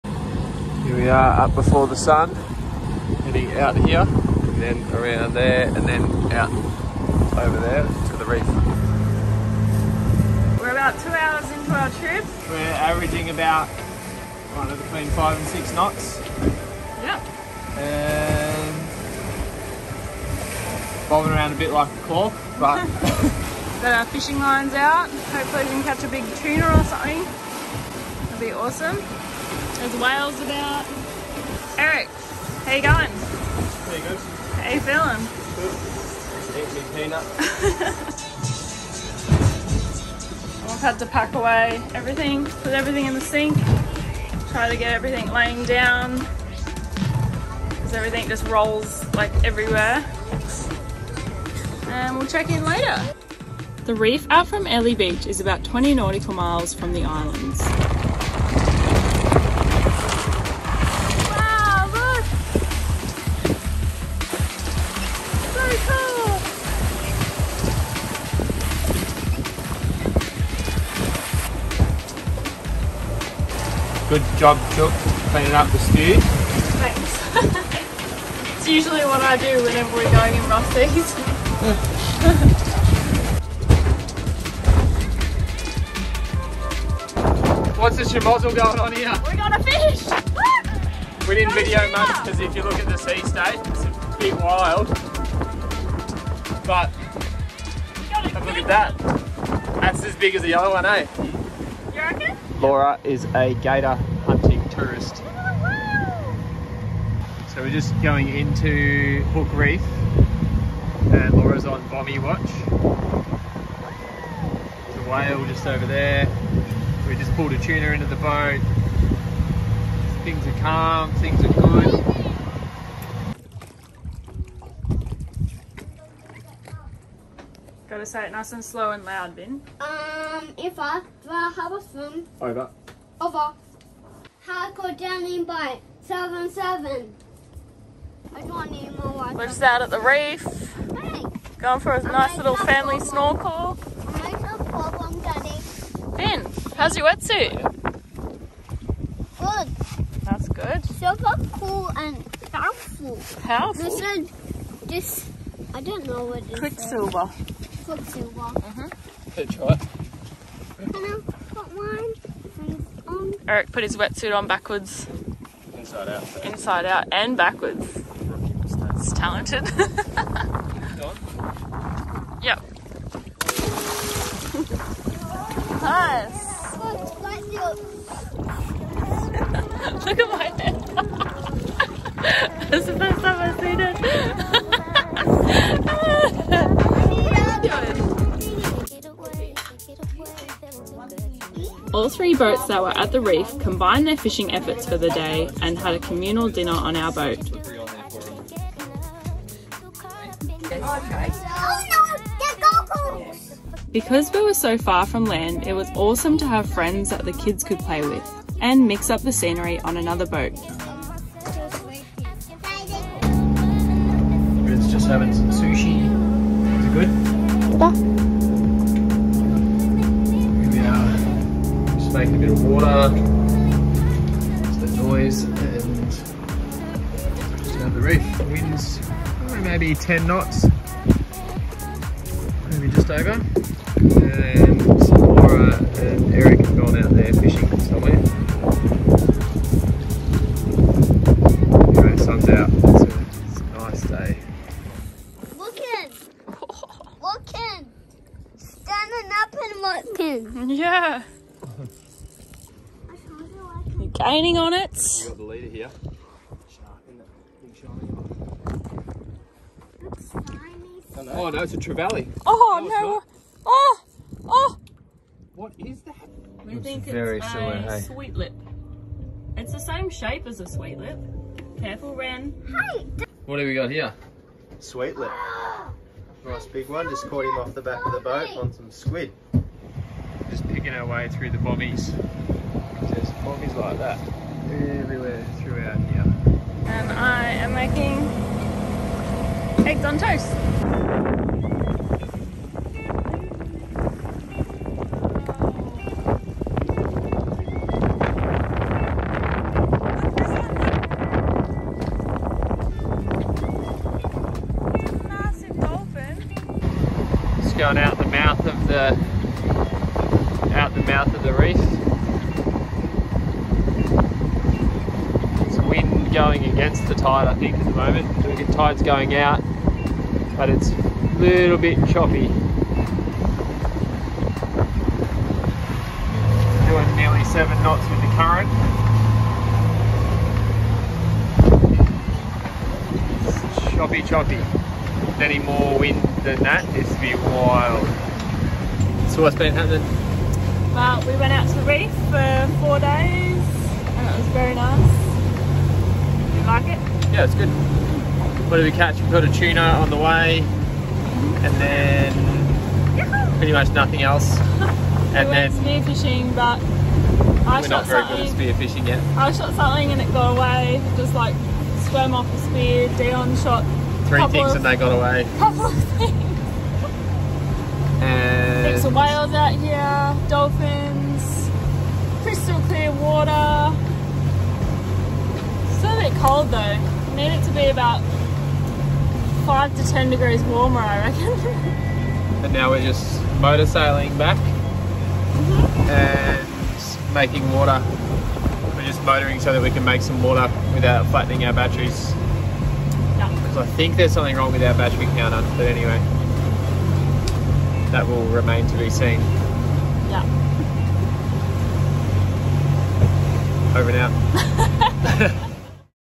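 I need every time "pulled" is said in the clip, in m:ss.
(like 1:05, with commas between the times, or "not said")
1:57.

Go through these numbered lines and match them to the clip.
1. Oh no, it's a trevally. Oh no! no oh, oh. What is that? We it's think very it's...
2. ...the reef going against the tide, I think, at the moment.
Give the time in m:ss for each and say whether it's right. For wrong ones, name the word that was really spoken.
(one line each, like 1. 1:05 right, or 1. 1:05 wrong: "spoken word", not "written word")
1. 4:21 right
2. 5:11 right.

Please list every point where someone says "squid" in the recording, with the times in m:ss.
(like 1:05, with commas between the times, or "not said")
4:38.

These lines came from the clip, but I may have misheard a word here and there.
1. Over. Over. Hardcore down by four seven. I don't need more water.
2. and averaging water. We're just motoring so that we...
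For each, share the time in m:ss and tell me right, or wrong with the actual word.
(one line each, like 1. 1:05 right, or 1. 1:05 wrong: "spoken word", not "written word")
1. 2:12 wrong: "seven", not "four"
2. 6:26 wrong: "making", not "averaging".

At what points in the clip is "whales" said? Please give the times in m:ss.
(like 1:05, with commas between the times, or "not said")
0:30, 1:55, 6:09.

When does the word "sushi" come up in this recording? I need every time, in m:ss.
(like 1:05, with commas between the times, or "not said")
3:35.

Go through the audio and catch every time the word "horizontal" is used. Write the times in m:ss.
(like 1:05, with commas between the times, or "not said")
not said.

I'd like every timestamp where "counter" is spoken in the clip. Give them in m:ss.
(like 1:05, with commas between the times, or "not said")
6:35.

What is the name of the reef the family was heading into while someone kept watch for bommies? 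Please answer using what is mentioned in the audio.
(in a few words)
Hook Reef.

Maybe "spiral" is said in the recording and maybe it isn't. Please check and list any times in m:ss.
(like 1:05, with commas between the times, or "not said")
not said.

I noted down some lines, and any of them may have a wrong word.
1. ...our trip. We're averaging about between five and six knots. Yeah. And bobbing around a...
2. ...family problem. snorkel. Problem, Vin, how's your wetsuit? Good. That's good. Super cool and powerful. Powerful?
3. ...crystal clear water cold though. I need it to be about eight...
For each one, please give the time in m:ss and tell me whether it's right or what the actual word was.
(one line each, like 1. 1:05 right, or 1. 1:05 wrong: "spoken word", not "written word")
1. 0:11 right
2. 2:22 right
3. 6:12 wrong: "five", not "eight".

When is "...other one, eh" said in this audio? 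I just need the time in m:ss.
1:40.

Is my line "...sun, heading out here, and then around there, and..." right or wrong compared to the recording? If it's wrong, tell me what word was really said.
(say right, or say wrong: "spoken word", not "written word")
right.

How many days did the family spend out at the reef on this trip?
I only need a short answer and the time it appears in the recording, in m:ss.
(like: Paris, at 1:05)
4, at 5:42.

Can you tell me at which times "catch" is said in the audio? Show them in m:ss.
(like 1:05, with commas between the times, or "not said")
0:25, 5:48.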